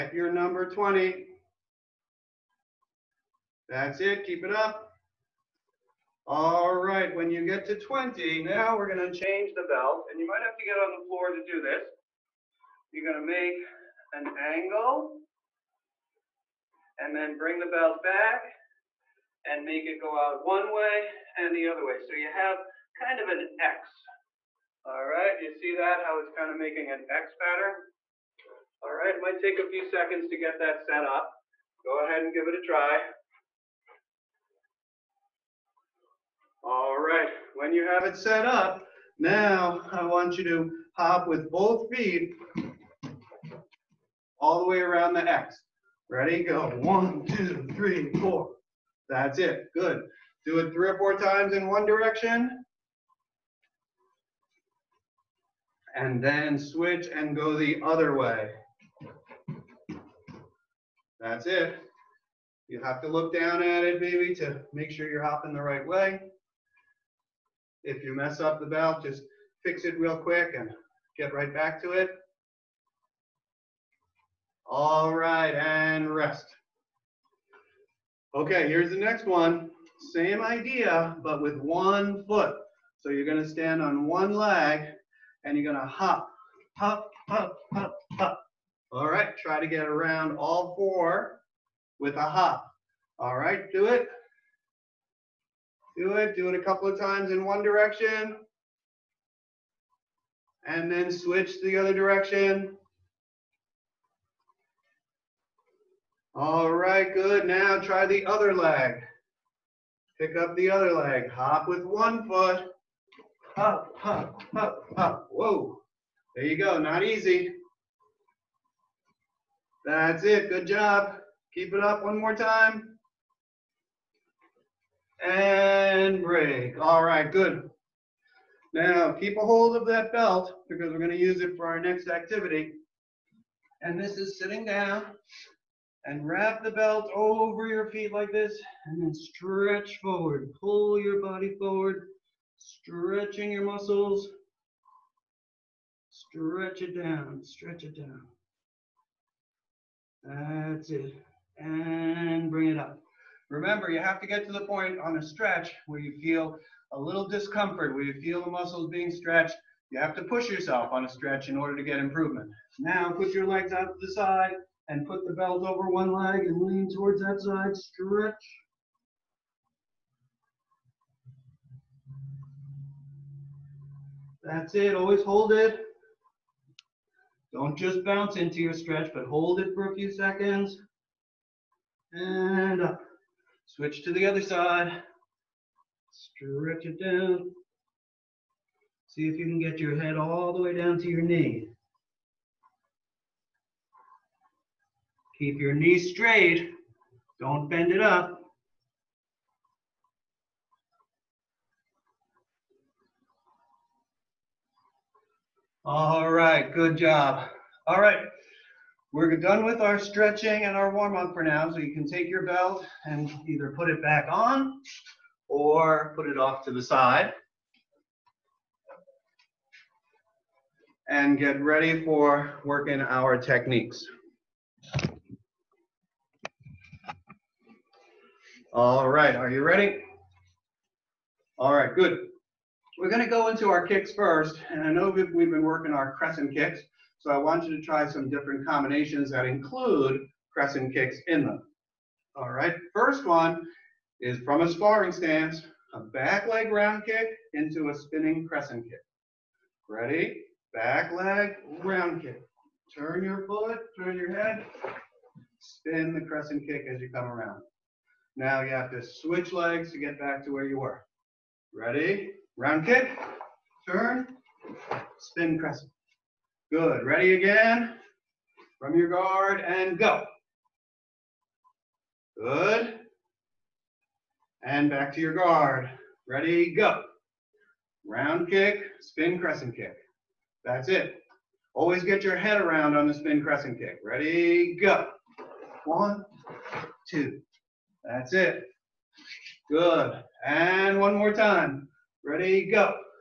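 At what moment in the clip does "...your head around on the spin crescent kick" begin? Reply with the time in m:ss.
4:42.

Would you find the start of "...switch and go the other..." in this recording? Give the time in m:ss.
0:56.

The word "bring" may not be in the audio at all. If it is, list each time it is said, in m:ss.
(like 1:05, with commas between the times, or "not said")
0:17, 2:32.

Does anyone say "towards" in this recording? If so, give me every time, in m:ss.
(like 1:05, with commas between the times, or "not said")
2:46.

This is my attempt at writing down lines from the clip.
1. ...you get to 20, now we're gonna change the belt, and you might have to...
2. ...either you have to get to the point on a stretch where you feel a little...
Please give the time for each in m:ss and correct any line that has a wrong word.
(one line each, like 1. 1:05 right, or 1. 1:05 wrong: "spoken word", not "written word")
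1. 0:07 right
2. 2:33 wrong: "remember", not "either".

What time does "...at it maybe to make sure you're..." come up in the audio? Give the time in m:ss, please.
1:03.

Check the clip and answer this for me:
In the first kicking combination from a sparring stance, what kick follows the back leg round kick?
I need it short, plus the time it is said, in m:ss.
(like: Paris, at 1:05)
Spinning crescent kick, at 4:07.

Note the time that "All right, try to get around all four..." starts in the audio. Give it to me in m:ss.
1:28.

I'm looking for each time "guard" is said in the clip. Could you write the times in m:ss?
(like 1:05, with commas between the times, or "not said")
4:29, 4:35.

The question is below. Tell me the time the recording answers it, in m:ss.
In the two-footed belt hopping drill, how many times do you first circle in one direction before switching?
0:50.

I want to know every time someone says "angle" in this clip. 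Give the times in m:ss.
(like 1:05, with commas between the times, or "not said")
0:14.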